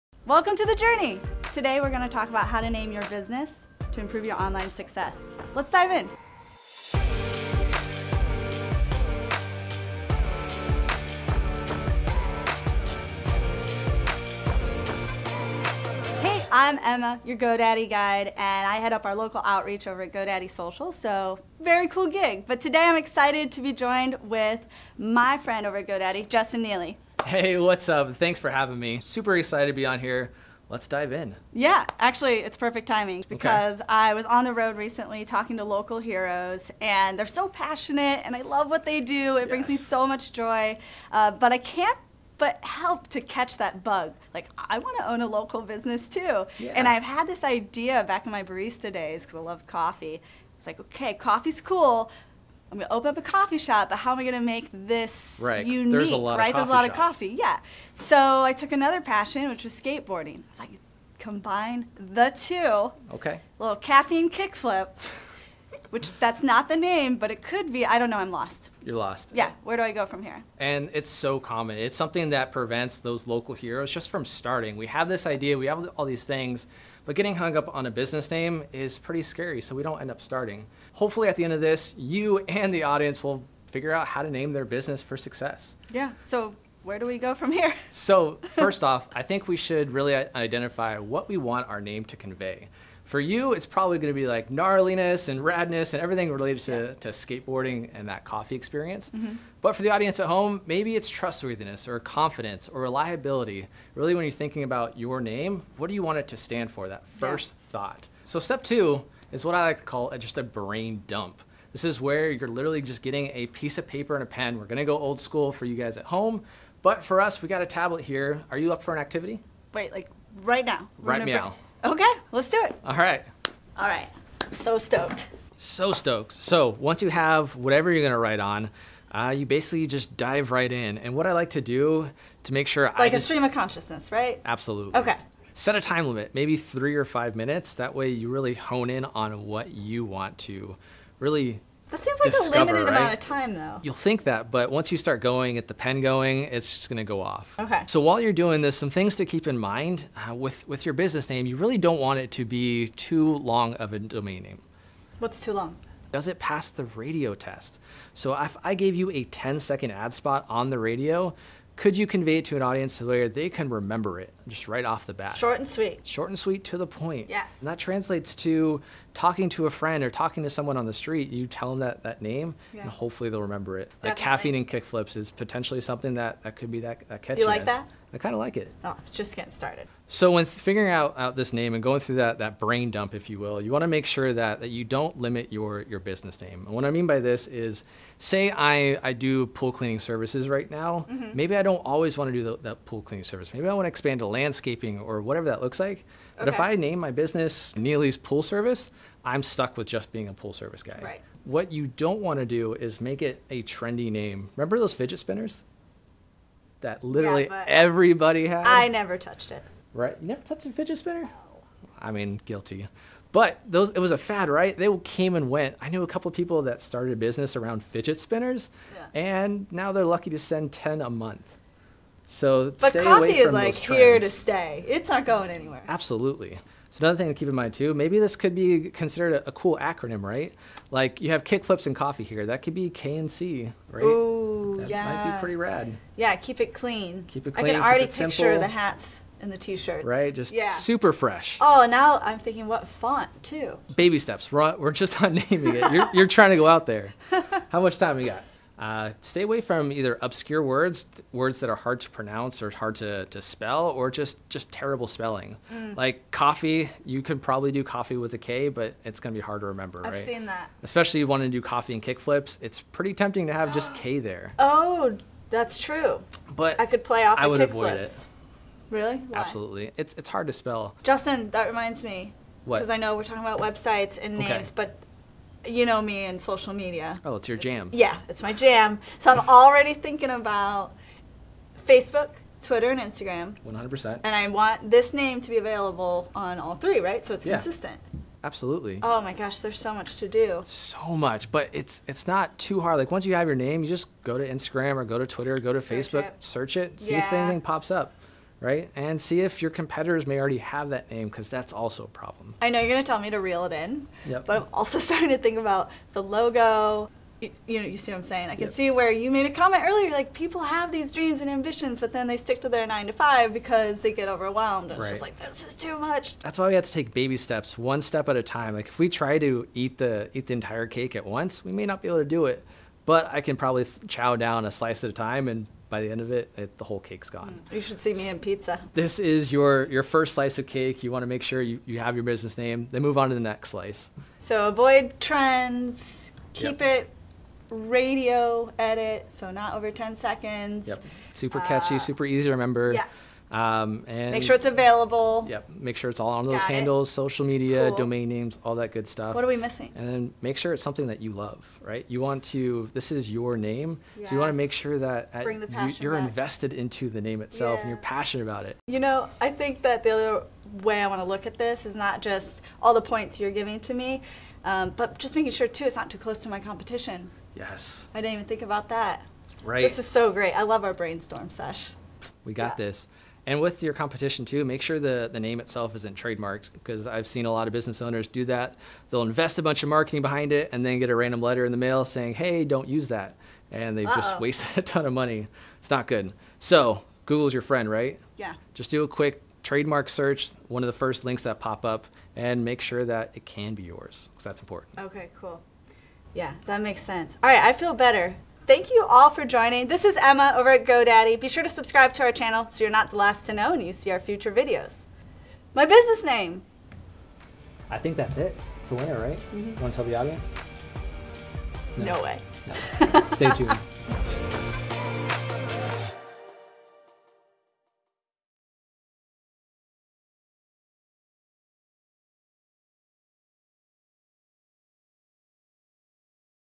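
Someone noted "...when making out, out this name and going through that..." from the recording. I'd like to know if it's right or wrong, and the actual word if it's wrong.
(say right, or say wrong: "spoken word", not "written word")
wrong: "figuring", not "making".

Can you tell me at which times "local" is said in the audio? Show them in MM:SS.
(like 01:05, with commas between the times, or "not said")
00:19, 00:35, 00:45, 01:13.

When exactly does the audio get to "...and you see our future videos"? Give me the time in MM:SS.
06:43.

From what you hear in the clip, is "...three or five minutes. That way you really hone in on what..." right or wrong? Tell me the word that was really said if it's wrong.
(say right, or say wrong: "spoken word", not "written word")
right.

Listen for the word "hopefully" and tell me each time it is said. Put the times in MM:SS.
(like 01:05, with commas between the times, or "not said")
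01:20, 02:52.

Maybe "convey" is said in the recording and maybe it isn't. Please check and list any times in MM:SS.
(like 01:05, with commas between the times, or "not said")
01:32, 02:42.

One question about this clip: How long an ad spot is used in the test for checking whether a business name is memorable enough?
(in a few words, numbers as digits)
10 seconds.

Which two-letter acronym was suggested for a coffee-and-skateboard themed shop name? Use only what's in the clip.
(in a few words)
K and C.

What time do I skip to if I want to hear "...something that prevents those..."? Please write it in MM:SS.
01:11.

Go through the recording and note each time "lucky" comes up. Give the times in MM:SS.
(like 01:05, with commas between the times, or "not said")
03:40.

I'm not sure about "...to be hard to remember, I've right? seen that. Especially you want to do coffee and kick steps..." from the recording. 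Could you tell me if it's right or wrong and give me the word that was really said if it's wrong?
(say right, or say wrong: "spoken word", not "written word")
wrong: "flips", not "steps".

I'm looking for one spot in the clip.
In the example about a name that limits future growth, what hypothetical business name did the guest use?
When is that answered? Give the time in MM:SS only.
03:17.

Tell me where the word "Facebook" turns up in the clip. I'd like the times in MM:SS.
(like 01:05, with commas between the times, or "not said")
04:41, 04:56.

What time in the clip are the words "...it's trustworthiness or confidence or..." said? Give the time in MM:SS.
01:40.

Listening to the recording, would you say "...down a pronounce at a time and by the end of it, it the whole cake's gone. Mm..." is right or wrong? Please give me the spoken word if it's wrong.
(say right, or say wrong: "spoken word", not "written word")
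wrong: "slice", not "pronounce".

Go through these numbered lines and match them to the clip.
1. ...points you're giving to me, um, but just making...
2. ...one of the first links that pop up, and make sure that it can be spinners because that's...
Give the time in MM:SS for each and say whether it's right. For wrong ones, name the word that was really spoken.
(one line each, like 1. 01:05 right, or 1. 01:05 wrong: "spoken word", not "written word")
1. 06:03 right
2. 06:30 wrong: "yours", not "spinners".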